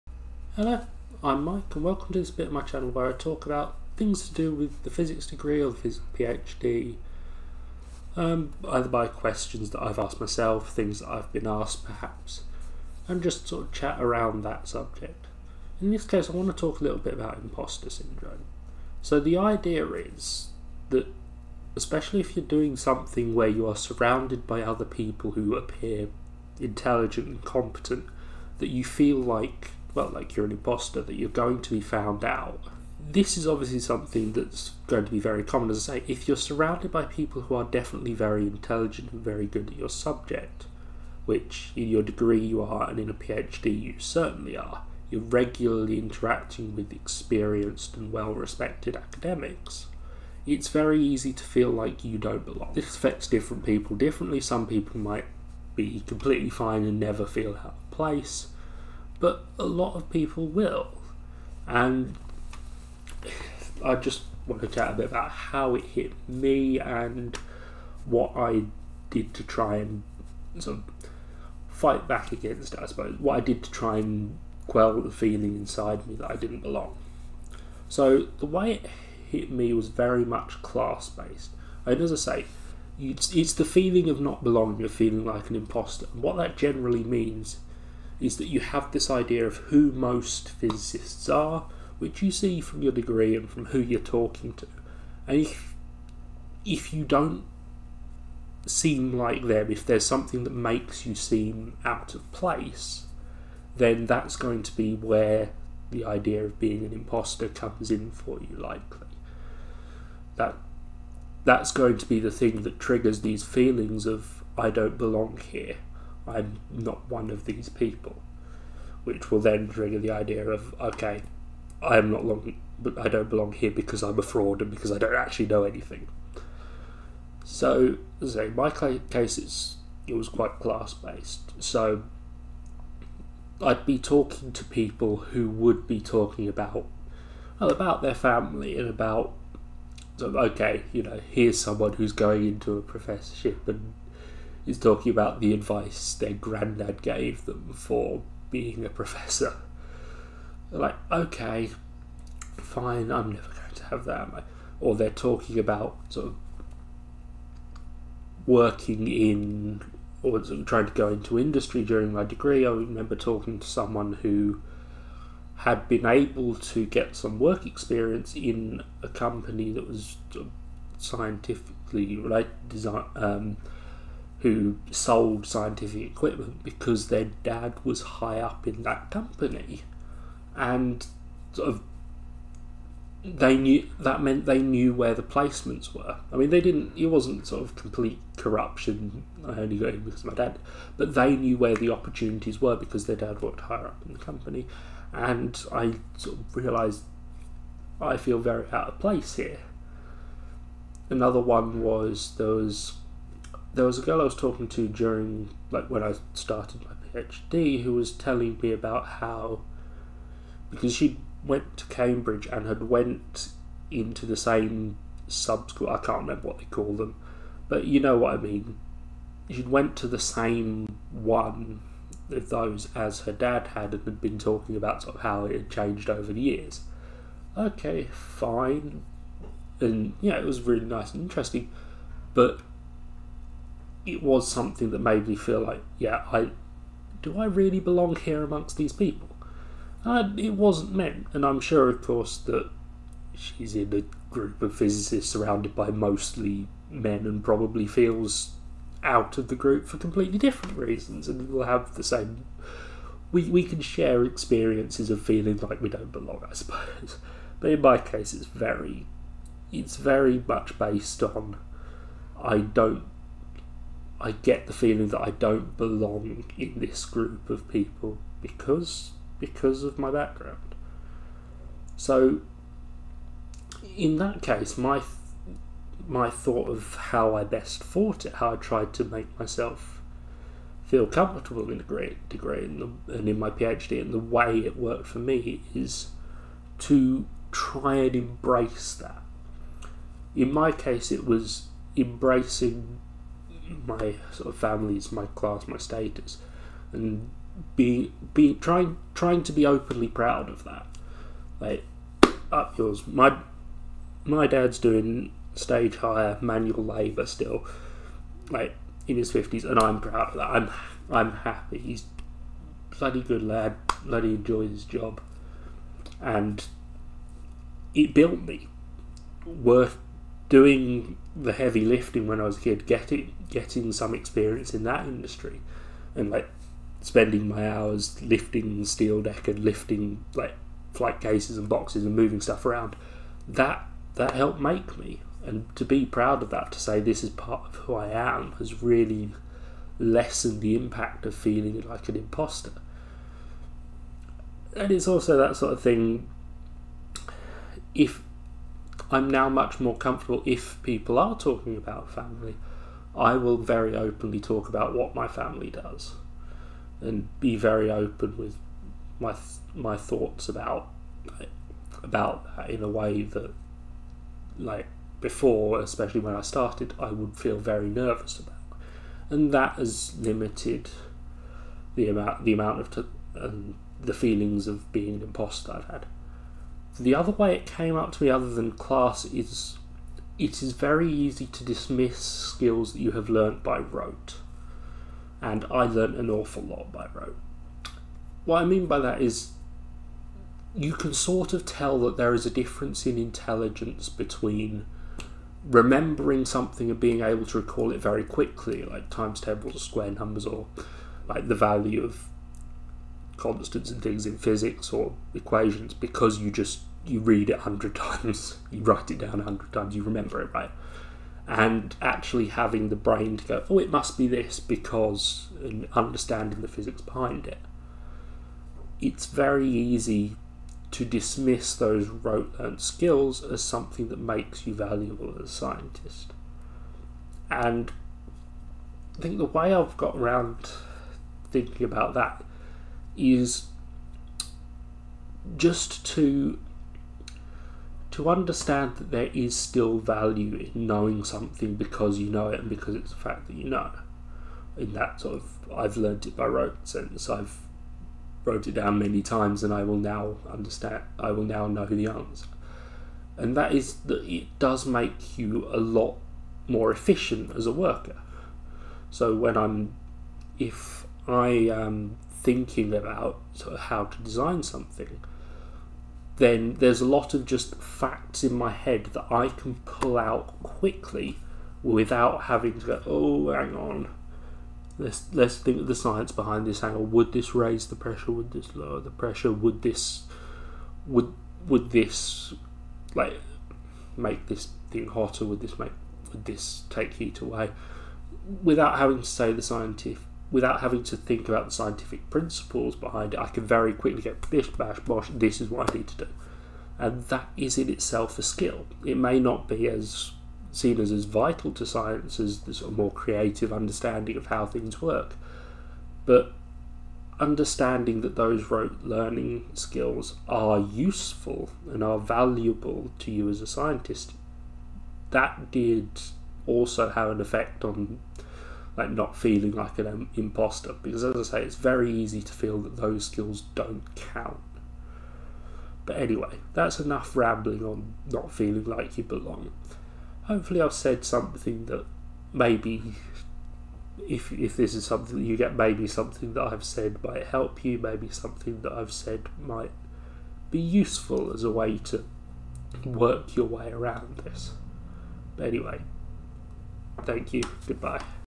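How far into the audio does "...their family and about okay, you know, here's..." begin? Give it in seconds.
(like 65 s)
138 s.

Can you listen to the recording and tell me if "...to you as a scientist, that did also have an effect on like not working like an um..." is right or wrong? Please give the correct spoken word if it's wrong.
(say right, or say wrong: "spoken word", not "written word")
wrong: "feeling", not "working".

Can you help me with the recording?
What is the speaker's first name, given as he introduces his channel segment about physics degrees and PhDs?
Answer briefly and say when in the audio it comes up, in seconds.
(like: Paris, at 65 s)
Mike, at 1 s.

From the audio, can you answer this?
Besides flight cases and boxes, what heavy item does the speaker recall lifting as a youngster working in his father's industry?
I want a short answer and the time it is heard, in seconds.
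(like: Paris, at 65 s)
Steel deck, at 328 s.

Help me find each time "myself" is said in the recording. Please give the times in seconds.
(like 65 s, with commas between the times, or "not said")
10 s, 279 s.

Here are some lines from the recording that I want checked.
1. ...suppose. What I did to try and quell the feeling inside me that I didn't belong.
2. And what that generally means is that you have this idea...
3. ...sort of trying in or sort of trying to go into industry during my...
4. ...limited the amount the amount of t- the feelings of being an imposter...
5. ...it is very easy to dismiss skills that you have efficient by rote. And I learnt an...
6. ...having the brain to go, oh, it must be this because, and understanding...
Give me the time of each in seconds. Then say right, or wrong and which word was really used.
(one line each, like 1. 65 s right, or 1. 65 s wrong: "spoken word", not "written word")
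1. 72 s right
2. 86 s right
3. 156 s wrong: "working", not "trying"
4. 370 s right
5. 380 s wrong: "learnt", not "efficient"
6. 412 s right.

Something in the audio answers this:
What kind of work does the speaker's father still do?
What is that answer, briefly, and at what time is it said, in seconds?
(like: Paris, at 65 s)
Stage hire manual labour, at 305 s.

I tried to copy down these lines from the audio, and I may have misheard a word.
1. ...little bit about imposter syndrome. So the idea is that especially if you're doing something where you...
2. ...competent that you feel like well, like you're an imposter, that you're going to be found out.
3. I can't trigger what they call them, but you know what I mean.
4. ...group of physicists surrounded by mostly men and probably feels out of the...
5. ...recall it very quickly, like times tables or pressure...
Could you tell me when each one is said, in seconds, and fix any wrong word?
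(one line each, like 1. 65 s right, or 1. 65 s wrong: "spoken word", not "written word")
1. 16 s right
2. 27 s right
3. 215 s wrong: "remember", not "trigger"
4. 244 s right
5. 397 s wrong: "square", not "pressure".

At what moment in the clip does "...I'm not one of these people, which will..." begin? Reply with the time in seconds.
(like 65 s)
116 s.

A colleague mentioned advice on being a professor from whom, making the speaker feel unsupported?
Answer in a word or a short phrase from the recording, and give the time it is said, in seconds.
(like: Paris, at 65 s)
Their granddad, at 146 s.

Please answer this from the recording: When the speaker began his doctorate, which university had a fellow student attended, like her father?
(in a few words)
Cambridge.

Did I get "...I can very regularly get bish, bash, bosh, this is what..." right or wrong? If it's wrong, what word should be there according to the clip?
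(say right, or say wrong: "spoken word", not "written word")
wrong: "quickly", not "regularly".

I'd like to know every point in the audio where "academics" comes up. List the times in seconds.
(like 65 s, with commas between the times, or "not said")
48 s.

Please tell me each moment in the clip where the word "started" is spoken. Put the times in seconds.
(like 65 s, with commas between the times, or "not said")
206 s, 366 s.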